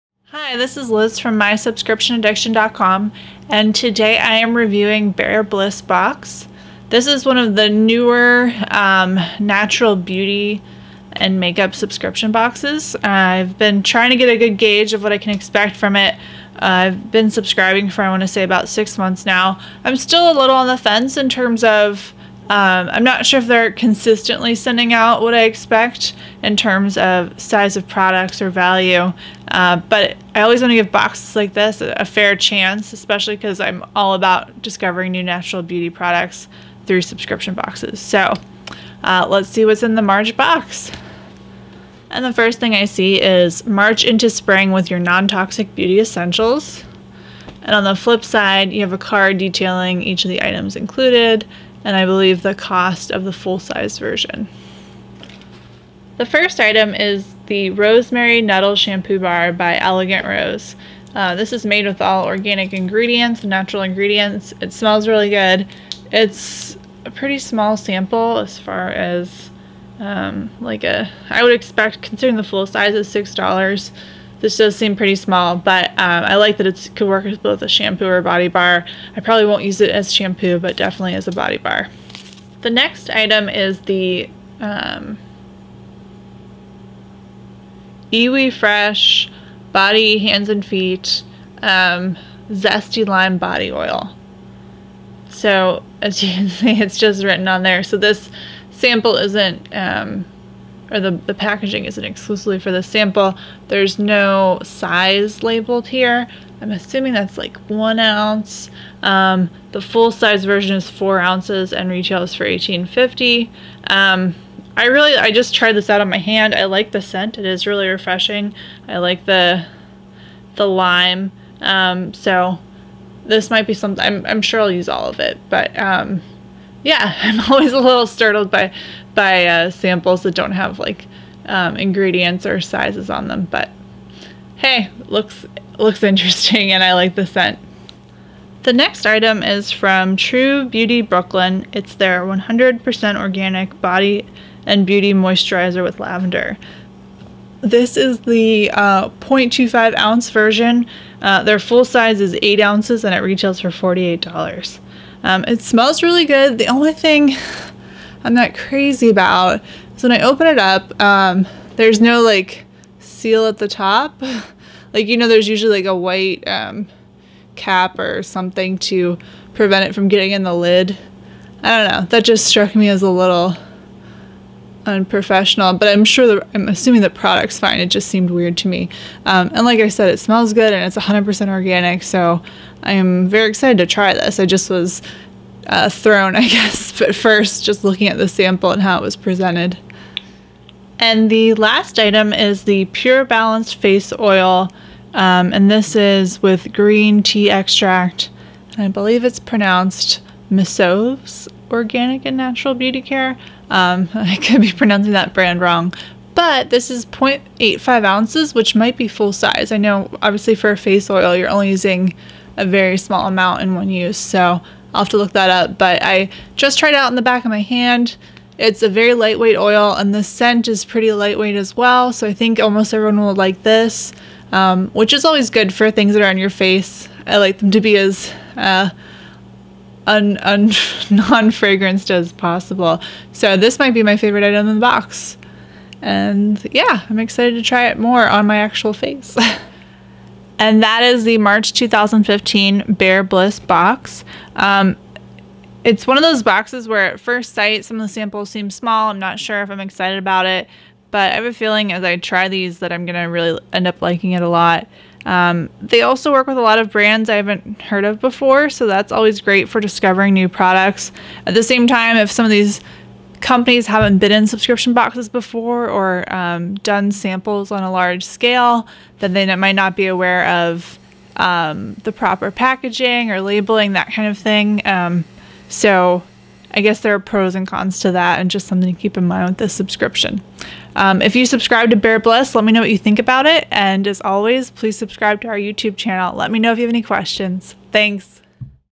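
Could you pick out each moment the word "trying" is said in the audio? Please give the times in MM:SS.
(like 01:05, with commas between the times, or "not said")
00:13.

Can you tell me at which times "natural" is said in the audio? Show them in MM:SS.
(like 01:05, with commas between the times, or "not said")
00:09, 00:35, 01:03, 03:22.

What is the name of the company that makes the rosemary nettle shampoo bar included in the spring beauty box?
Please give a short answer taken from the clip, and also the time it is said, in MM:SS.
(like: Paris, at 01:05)
Elegant Rose, at 00:59.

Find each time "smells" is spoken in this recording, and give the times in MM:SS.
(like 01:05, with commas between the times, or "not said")
01:04, 02:35, 03:00.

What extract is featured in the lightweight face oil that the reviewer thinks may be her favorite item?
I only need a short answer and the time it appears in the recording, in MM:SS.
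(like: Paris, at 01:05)
green tea, at 03:16.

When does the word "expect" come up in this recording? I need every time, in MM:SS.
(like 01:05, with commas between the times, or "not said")
00:15, 00:25, 01:11.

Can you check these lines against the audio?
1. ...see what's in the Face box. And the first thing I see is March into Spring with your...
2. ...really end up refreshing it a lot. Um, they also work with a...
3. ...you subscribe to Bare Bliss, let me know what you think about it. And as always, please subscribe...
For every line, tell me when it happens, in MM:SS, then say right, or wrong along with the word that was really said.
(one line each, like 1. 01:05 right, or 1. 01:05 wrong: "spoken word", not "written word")
1. 00:39 wrong: "March", not "Face"
2. 04:13 wrong: "liking", not "refreshing"
3. 04:41 right.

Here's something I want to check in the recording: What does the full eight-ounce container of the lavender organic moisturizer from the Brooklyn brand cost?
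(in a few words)
$48.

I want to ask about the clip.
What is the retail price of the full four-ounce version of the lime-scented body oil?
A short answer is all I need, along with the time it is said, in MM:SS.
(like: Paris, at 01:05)
$18.50, at 01:52.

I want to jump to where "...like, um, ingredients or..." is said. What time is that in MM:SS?
02:10.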